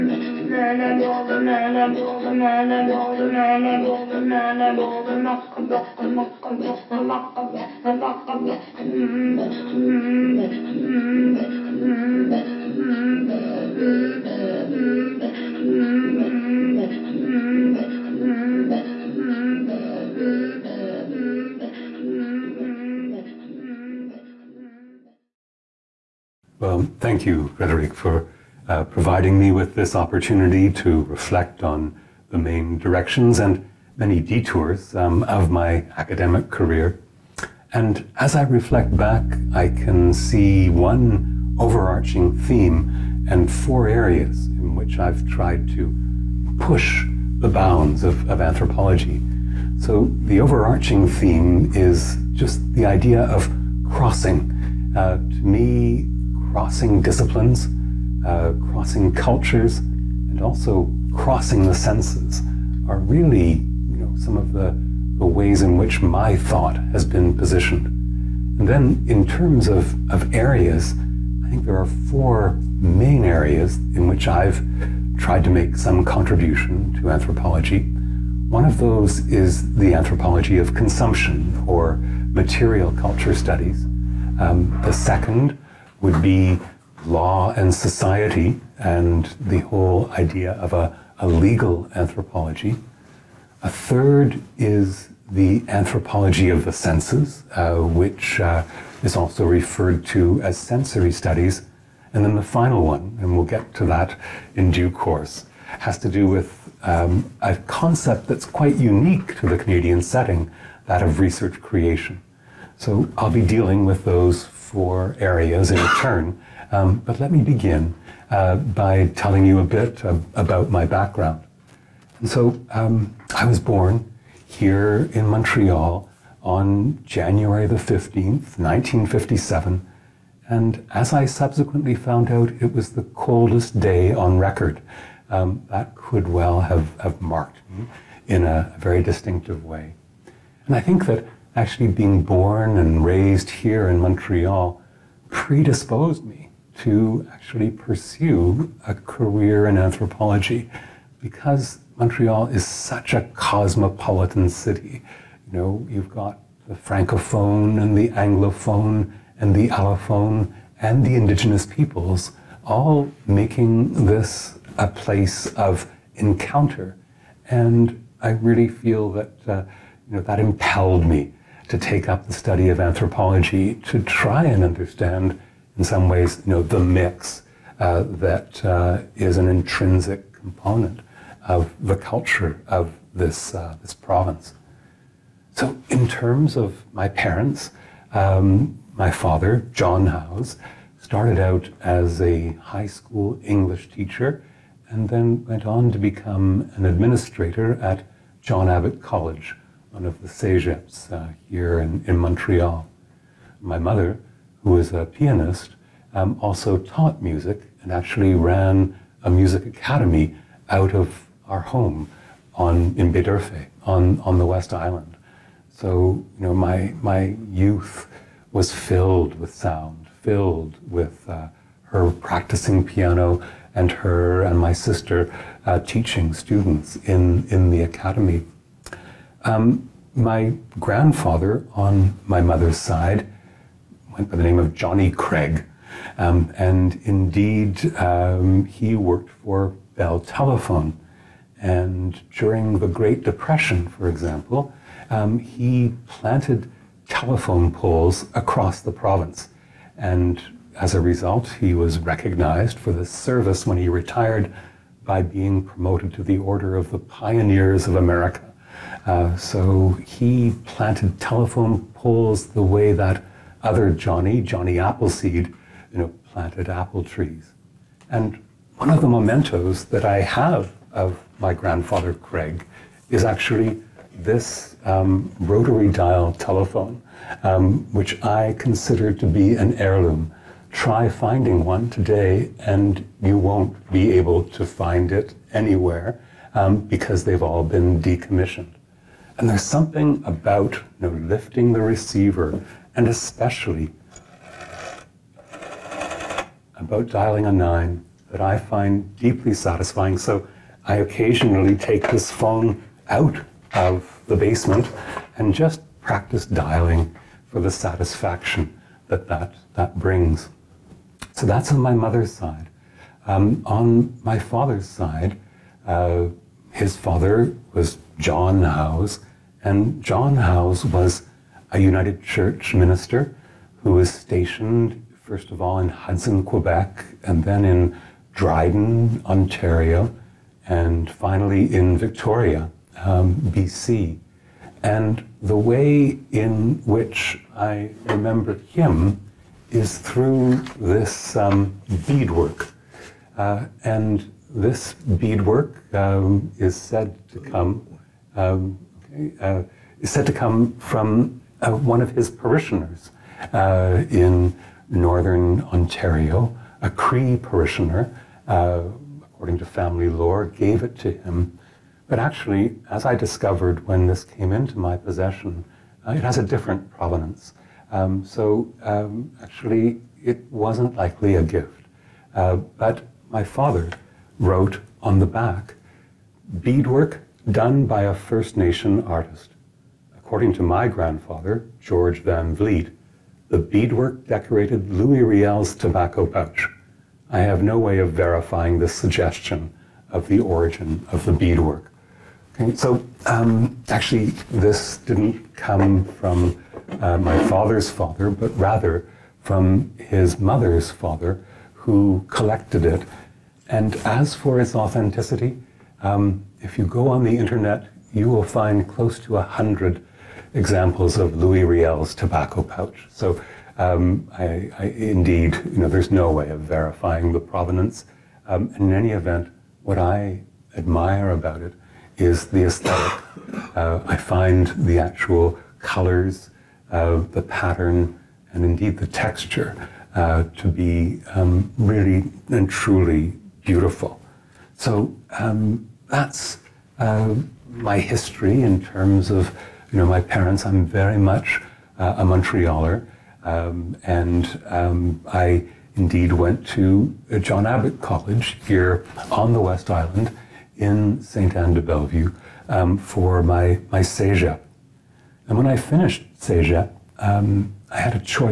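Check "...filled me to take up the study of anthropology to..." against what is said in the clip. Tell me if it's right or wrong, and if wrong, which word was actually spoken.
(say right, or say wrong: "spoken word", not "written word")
wrong: "impelled", not "filled".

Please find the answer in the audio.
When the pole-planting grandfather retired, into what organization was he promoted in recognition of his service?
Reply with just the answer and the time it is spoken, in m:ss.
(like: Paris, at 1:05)
Order of the Pioneers of America, at 4:16.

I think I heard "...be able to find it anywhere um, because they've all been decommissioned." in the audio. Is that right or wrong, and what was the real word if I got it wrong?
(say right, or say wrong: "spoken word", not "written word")
right.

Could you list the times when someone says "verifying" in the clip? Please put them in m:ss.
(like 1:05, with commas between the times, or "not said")
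6:28, 6:56.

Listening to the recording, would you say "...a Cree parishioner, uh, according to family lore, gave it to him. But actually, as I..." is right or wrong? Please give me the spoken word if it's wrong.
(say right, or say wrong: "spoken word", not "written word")
right.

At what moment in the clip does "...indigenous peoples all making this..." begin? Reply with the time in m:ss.
2:41.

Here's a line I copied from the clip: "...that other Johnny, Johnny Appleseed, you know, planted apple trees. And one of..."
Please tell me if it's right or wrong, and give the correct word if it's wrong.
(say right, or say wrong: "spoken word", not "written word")
right.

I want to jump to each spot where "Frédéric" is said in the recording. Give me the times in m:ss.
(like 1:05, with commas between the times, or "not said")
0:27.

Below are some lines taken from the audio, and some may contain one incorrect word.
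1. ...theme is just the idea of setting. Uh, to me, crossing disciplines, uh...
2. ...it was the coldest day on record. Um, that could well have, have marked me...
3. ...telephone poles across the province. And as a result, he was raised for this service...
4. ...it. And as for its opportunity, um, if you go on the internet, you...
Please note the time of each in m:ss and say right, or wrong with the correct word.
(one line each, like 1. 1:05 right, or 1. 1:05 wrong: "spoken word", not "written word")
1. 0:51 wrong: "crossing", not "setting"
2. 2:12 right
3. 4:07 wrong: "recognized", not "raised"
4. 6:42 wrong: "authenticity", not "opportunity".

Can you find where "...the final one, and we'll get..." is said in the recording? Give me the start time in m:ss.
1:42.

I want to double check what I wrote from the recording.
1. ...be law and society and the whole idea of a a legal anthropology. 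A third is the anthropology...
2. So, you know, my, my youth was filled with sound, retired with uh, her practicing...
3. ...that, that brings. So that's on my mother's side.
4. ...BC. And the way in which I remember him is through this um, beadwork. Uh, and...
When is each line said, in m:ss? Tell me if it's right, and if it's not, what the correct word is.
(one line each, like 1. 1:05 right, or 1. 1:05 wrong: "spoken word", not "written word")
1. 1:26 right
2. 3:35 wrong: "filled", not "retired"
3. 5:09 right
4. 5:33 right.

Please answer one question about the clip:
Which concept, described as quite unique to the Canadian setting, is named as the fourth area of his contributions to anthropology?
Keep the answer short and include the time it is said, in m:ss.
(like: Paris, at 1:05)
Research creation, at 1:51.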